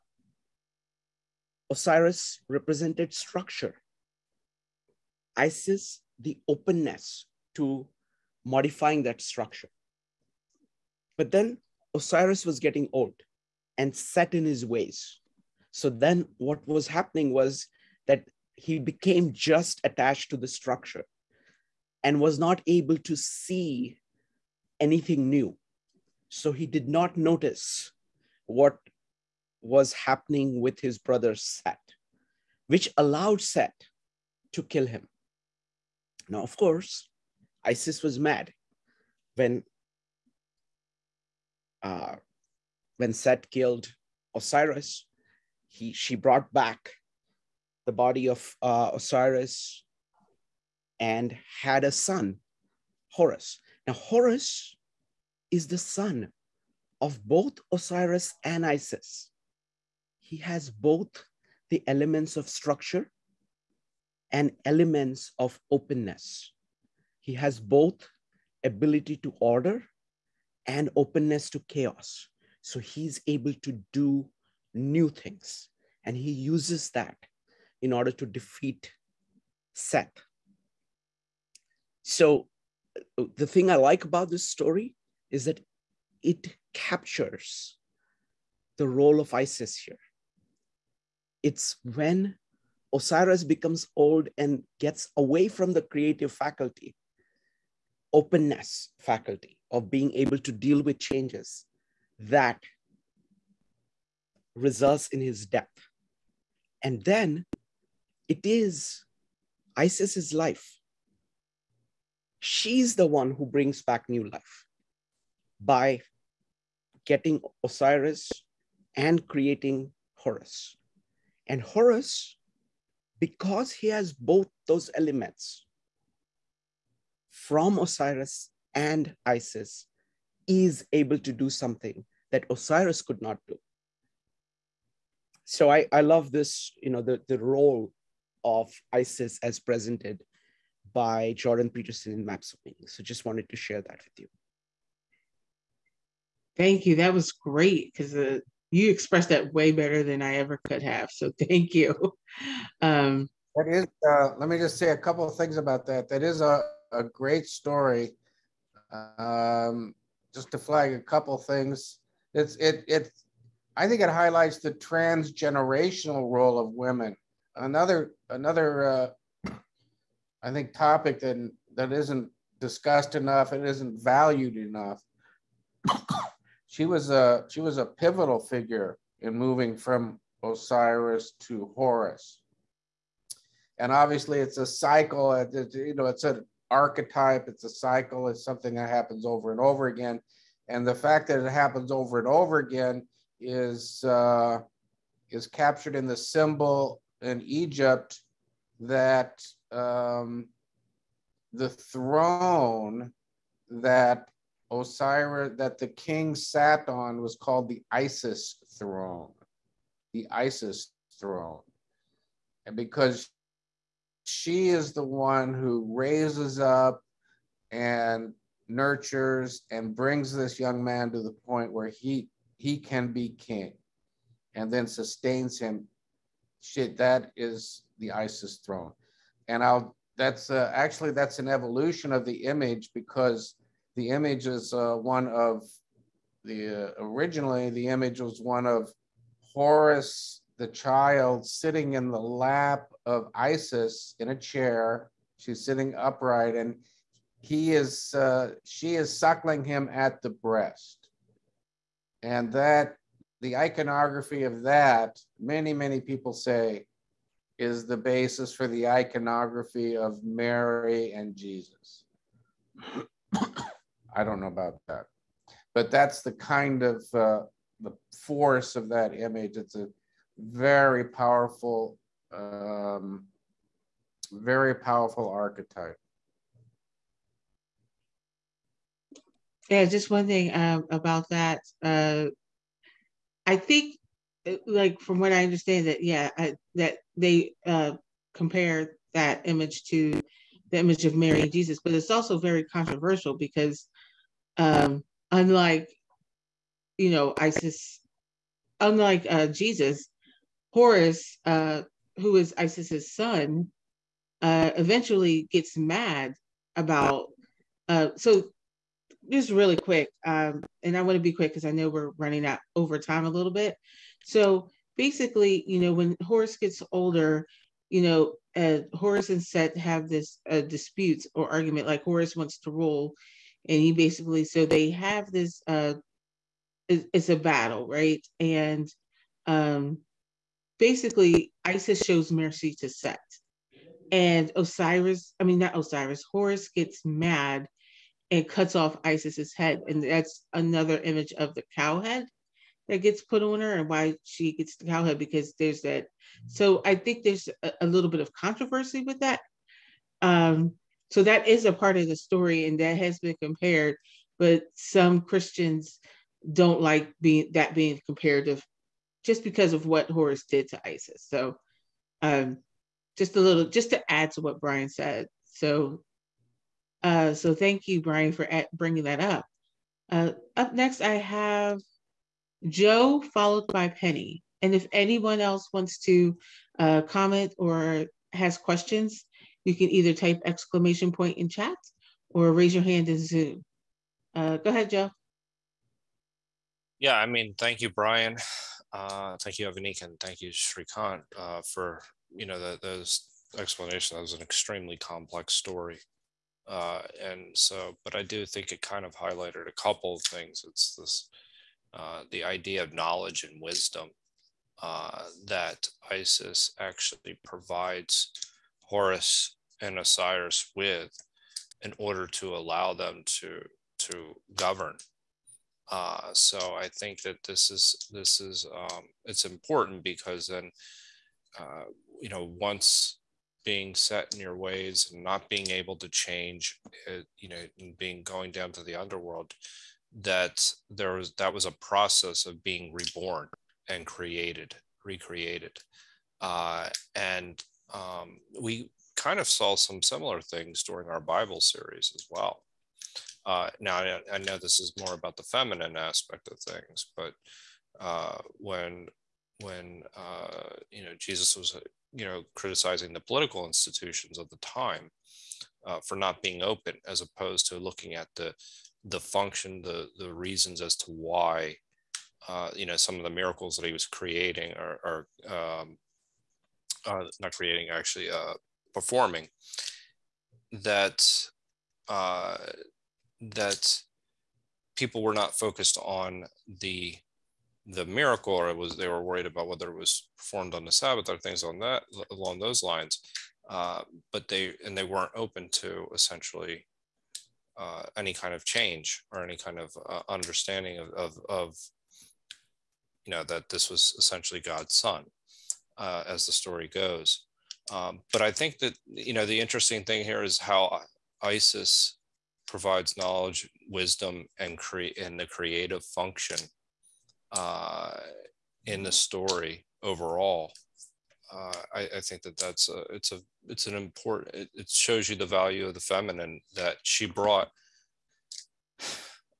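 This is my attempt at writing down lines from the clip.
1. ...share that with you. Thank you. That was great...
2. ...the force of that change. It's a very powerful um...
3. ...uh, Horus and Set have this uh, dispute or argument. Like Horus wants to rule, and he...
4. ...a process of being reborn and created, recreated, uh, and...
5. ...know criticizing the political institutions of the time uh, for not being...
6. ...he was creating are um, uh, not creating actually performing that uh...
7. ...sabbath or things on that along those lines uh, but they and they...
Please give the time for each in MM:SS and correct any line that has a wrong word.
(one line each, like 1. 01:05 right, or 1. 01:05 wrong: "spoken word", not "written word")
1. 02:23 right
2. 04:27 wrong: "image", not "change"
3. 05:18 right
4. 07:11 right
5. 07:32 right
6. 07:43 right
7. 08:00 right.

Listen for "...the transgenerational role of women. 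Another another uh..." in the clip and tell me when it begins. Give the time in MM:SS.
02:44.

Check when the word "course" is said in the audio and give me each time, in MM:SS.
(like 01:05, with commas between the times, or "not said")
00:36.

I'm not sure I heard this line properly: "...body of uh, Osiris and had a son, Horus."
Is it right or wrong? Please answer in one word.
right.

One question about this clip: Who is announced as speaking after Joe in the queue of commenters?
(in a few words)
Penny.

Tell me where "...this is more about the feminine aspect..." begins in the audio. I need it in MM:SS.
07:24.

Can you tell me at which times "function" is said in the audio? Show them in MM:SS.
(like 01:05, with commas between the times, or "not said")
07:39, 08:26.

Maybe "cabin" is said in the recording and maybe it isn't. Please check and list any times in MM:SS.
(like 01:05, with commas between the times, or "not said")
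not said.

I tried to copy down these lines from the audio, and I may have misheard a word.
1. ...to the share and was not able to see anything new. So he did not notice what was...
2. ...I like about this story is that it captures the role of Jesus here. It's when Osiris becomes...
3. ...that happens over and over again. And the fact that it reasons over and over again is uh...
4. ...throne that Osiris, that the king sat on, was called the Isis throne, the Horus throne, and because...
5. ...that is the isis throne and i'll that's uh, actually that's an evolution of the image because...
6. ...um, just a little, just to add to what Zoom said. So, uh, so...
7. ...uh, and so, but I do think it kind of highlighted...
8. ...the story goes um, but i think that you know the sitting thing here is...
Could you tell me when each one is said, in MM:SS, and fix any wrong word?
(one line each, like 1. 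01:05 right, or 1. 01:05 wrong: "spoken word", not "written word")
1. 00:20 wrong: "structure", not "share"
2. 01:23 wrong: "Isis", not "Jesus"
3. 03:08 wrong: "happens", not "reasons"
4. 03:21 wrong: "Isis", not "Horus"
5. 03:46 right
6. 06:02 wrong: "Brian", not "Zoom"
7. 06:36 right
8. 08:16 wrong: "interesting", not "sitting".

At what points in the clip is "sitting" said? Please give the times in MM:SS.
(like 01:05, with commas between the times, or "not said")
04:01, 04:05.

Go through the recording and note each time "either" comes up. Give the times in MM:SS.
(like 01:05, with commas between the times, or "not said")
06:19.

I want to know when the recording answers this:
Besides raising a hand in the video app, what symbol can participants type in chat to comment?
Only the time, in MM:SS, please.
06:20.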